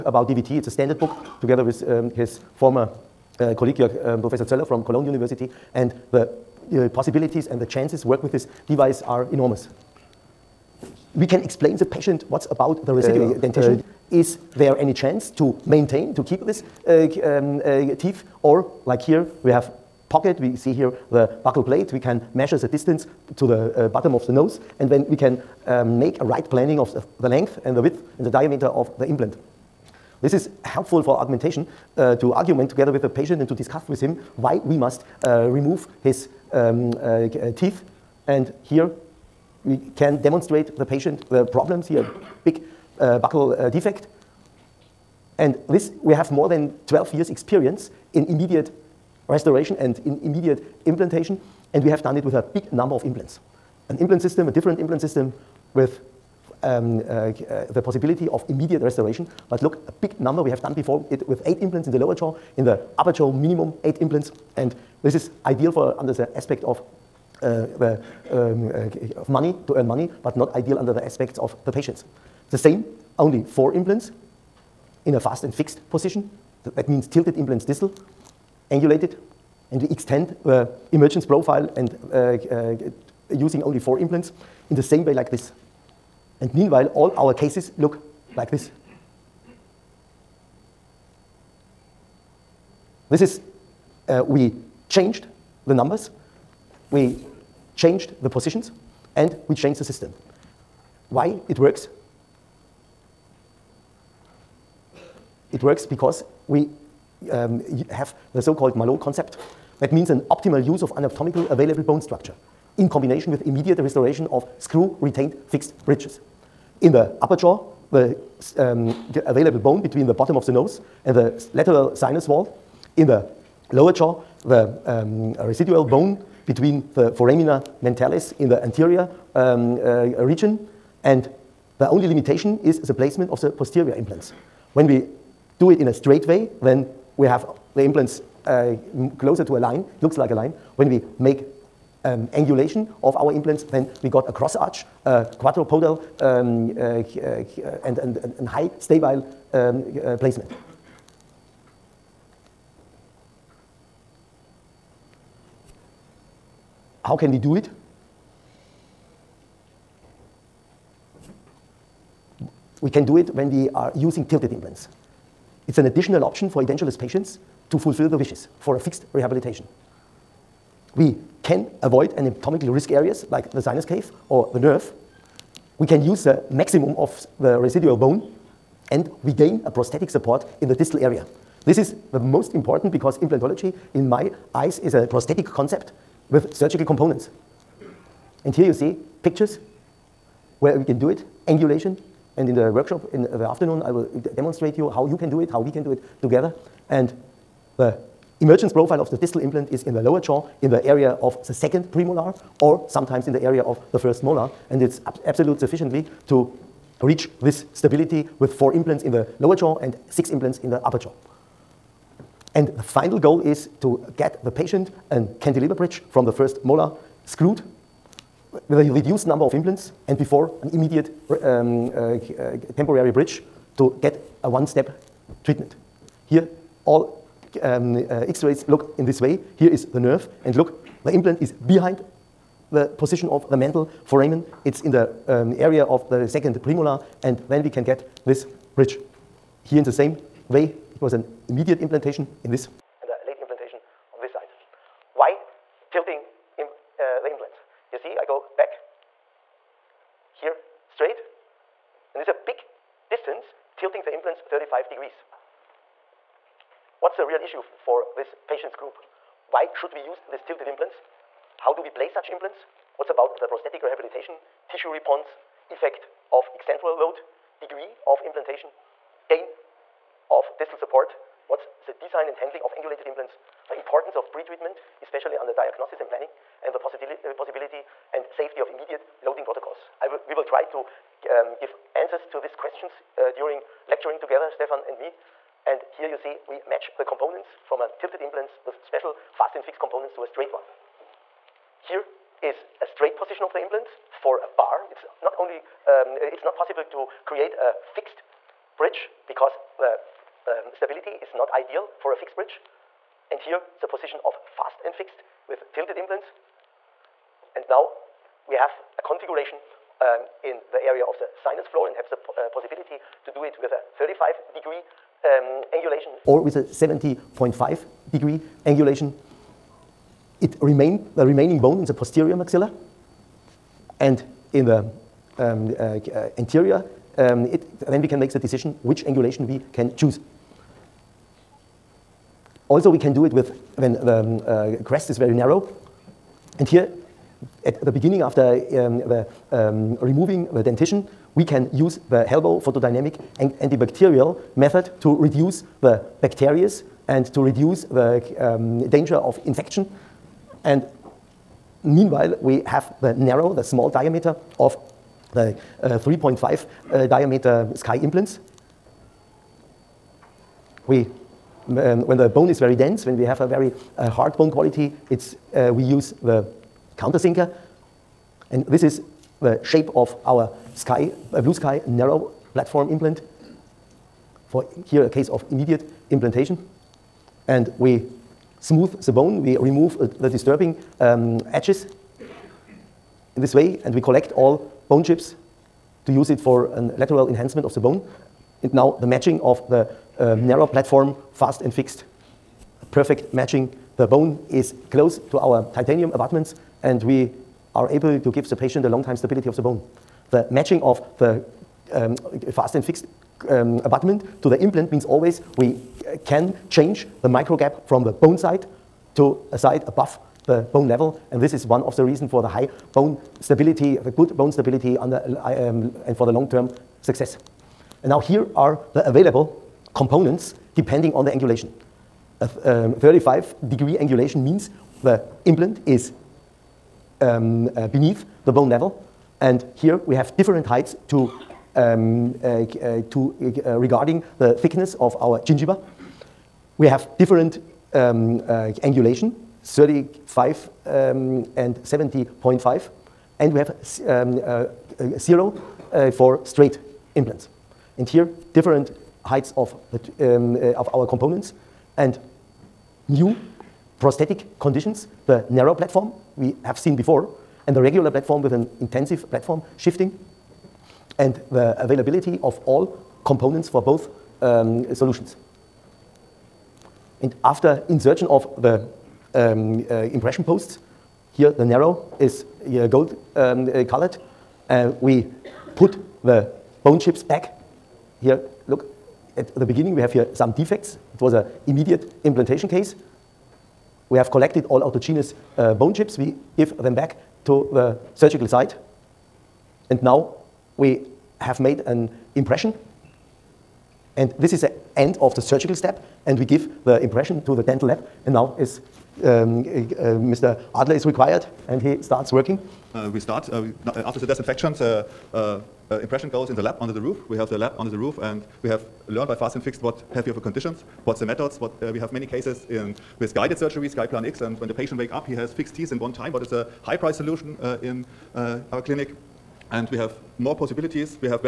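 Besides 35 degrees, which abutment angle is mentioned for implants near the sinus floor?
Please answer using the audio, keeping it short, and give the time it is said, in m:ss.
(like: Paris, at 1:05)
70.5 degrees, at 5:16.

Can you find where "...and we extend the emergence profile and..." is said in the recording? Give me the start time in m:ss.
1:19.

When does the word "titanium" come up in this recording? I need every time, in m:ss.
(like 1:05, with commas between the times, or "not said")
6:35.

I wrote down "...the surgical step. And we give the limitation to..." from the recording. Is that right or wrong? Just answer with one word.
wrong.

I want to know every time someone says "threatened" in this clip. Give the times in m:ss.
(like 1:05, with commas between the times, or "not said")
not said.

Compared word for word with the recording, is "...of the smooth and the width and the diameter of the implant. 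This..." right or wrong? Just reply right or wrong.
wrong.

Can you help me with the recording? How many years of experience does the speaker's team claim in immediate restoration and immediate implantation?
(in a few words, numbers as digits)
more than 12 years.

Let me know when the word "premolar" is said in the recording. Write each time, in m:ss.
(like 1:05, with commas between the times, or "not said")
3:21, 3:56.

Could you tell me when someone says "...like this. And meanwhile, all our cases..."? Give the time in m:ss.
1:25.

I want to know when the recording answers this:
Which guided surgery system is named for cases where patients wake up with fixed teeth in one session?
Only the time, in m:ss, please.
8:33.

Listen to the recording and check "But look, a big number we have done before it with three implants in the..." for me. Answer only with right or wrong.
wrong.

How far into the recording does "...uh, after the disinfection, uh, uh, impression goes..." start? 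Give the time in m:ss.
8:23.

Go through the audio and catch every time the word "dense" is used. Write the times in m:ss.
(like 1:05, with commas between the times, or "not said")
6:02.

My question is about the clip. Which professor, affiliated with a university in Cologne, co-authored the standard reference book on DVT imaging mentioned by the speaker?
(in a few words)
Zöller.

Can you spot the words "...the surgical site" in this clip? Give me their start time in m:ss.
8:07.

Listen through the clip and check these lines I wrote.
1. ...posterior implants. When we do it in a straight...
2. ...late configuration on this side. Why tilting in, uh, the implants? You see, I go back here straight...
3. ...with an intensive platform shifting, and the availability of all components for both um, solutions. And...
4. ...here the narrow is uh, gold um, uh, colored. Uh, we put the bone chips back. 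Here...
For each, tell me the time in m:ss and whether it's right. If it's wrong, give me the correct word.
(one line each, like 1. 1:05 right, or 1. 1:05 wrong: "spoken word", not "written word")
1. 2:13 right
2. 4:03 wrong: "implantation", not "configuration"
3. 7:38 right
4. 7:51 right.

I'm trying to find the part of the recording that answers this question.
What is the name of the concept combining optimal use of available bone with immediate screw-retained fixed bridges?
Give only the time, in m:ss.
1:48.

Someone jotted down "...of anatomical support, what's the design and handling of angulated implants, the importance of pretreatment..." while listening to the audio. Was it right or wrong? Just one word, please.
wrong.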